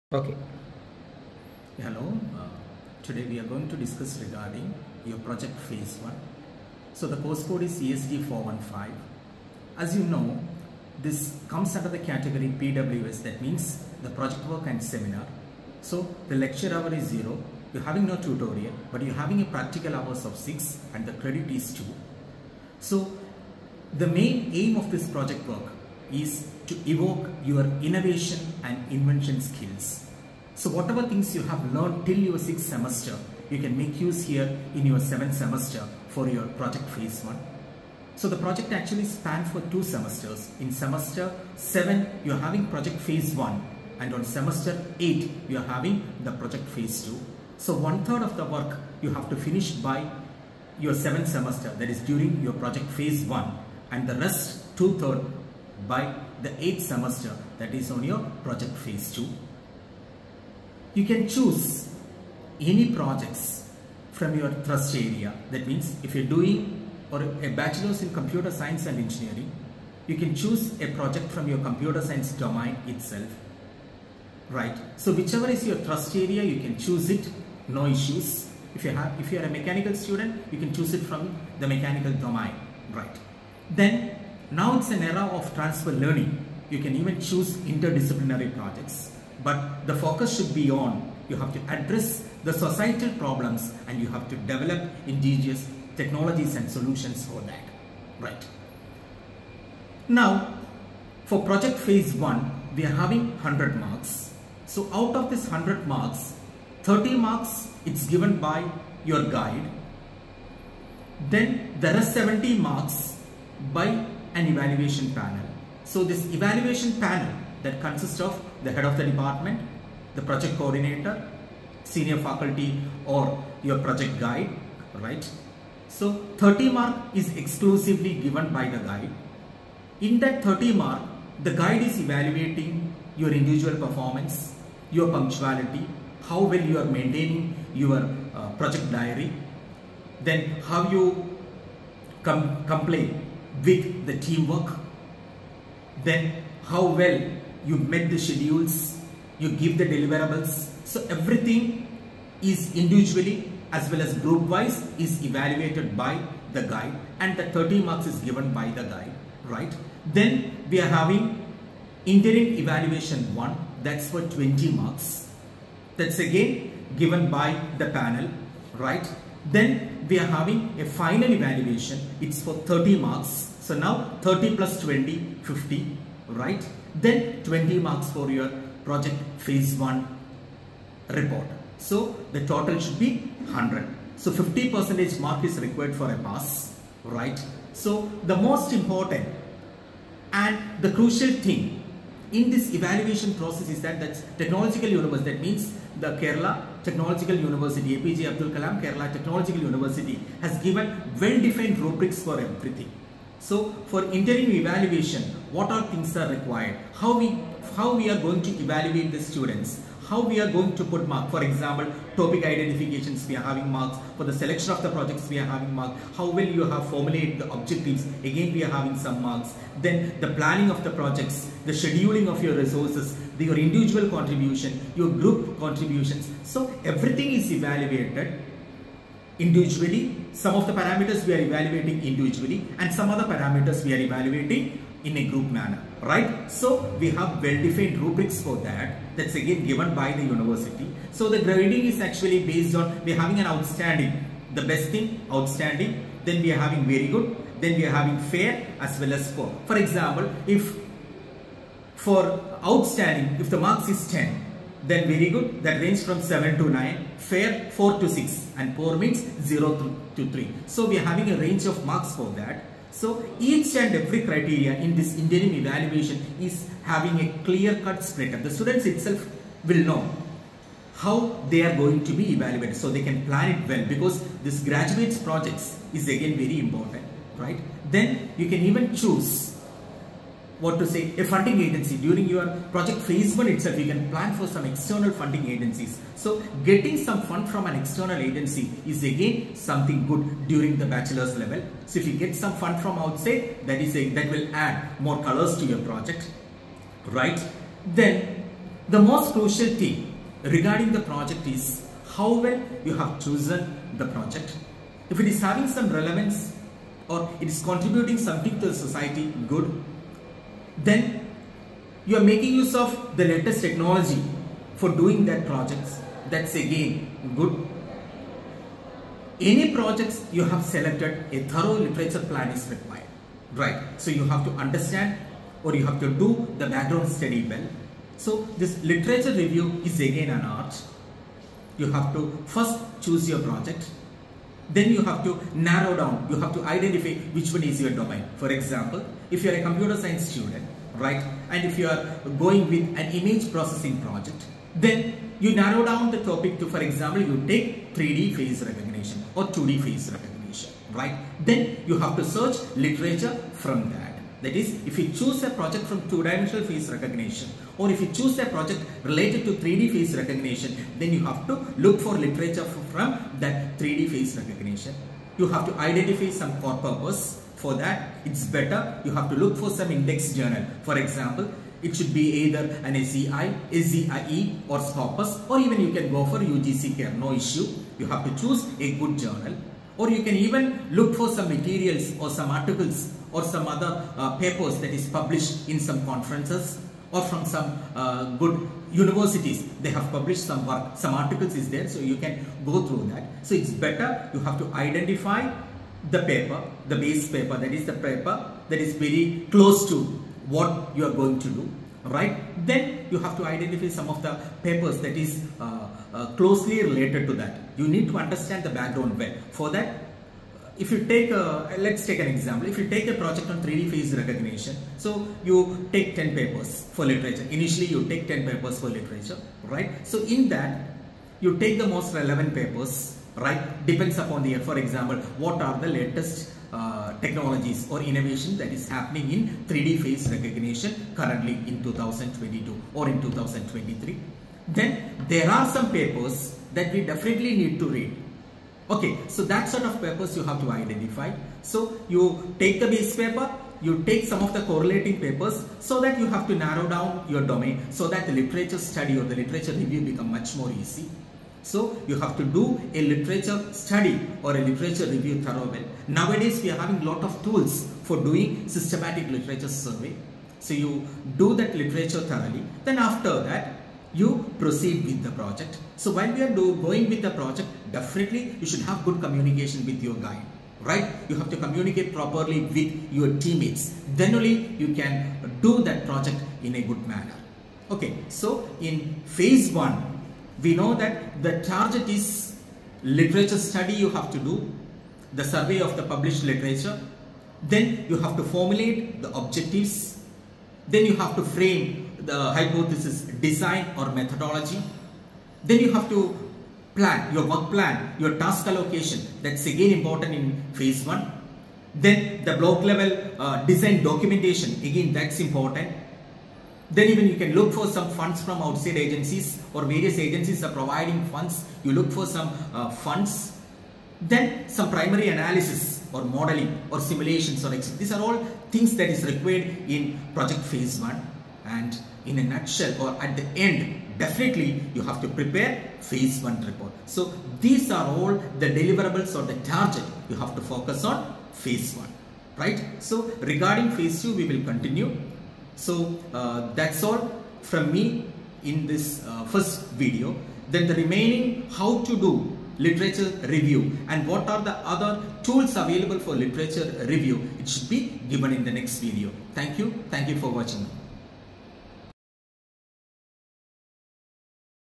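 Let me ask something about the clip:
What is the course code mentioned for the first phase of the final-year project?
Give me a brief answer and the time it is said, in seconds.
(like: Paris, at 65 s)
ESD415, at 7 s.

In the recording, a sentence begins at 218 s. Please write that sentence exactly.
Again, we are having some marks.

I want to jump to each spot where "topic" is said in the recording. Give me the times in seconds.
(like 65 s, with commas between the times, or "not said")
212 s, 346 s.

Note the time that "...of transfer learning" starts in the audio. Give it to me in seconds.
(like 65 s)
85 s.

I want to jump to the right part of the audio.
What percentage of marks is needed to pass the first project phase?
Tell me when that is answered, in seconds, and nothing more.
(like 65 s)
184 s.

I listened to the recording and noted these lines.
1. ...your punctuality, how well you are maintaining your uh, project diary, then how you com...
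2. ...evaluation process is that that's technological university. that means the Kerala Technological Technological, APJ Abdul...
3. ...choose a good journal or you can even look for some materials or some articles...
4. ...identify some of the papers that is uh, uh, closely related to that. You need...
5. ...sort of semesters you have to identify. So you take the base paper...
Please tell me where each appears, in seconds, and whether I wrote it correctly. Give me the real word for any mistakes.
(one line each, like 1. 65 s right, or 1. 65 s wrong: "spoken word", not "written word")
1. 134 s right
2. 192 s wrong: "University", not "Technological"
3. 378 s right
4. 403 s right
5. 439 s wrong: "papers", not "semesters".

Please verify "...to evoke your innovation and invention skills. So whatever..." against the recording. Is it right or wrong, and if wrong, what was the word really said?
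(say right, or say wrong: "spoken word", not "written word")
right.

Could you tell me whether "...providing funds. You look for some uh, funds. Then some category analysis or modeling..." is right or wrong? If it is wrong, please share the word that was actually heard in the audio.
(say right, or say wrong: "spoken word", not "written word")
wrong: "primary", not "category".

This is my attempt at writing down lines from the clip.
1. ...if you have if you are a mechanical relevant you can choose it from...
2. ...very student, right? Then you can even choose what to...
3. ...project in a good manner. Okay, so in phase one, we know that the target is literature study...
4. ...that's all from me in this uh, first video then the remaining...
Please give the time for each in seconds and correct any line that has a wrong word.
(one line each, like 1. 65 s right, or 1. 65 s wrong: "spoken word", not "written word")
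1. 78 s wrong: "student", not "relevant"
2. 276 s wrong: "important", not "student"
3. 476 s right
4. 536 s right.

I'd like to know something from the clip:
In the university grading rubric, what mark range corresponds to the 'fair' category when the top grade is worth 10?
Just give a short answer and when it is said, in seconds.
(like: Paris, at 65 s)
4 to 6, at 257 s.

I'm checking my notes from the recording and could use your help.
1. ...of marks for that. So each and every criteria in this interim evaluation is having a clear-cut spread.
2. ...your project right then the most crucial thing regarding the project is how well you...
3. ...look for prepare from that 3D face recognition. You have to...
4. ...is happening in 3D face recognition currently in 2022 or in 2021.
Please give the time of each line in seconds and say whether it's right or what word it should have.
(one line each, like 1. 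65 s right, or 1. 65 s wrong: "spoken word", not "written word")
1. 261 s right
2. 295 s right
3. 361 s wrong: "literature", not "prepare"
4. 428 s wrong: "2023", not "2021".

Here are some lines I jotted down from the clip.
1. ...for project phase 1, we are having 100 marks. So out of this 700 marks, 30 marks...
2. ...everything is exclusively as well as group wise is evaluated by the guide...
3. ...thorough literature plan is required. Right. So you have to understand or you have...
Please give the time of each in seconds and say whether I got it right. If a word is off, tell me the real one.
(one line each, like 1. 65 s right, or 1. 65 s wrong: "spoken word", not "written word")
1. 101 s wrong: "100", not "700"
2. 151 s wrong: "individually", not "exclusively"
3. 321 s right.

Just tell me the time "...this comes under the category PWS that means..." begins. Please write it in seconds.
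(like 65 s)
11 s.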